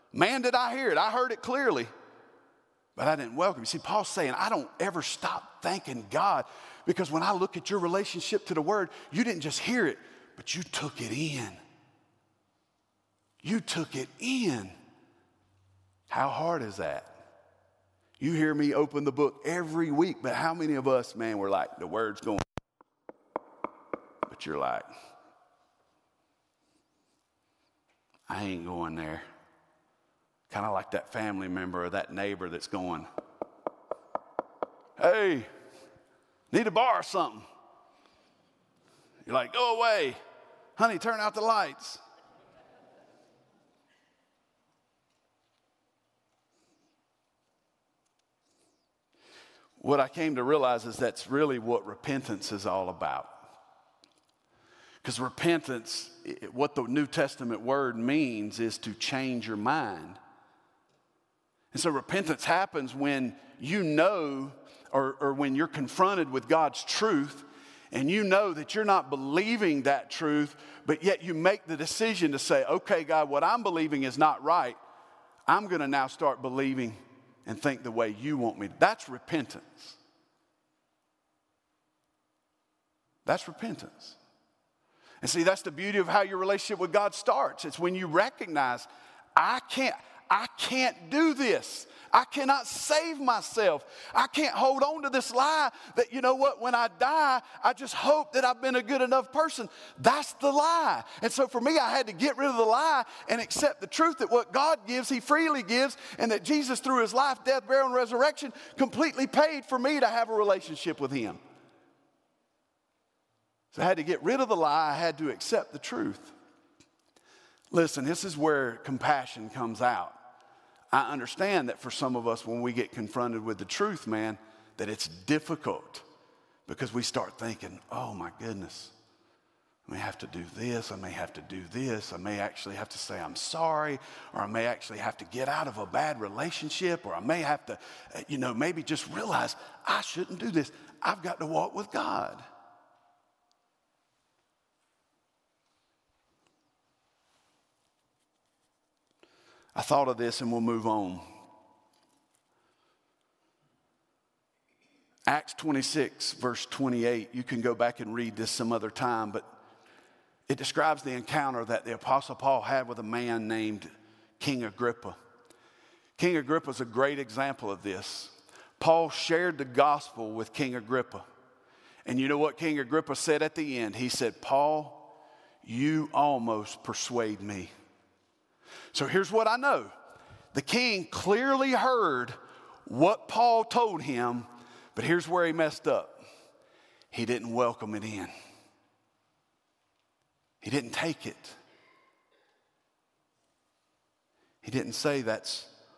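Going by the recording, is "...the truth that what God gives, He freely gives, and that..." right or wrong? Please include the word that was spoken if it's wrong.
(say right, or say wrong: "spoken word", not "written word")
right.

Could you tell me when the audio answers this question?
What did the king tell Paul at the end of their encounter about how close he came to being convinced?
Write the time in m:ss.
2:55.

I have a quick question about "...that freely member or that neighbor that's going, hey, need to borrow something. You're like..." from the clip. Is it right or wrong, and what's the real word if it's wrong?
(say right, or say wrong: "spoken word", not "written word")
wrong: "family", not "freely".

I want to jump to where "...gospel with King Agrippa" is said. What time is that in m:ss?
2:49.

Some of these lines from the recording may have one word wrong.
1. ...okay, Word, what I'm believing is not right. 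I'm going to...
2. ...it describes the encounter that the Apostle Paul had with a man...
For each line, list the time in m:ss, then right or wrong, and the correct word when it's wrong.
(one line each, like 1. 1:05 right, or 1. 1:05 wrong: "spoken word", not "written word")
1. 1:12 wrong: "God", not "Word"
2. 2:40 right.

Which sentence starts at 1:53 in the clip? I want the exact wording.
So I had to get rid of the lie, I had to accept the truth.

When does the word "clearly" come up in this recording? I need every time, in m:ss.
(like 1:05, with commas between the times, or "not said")
0:01, 3:01.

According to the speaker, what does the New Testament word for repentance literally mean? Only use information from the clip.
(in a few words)
To change your mind.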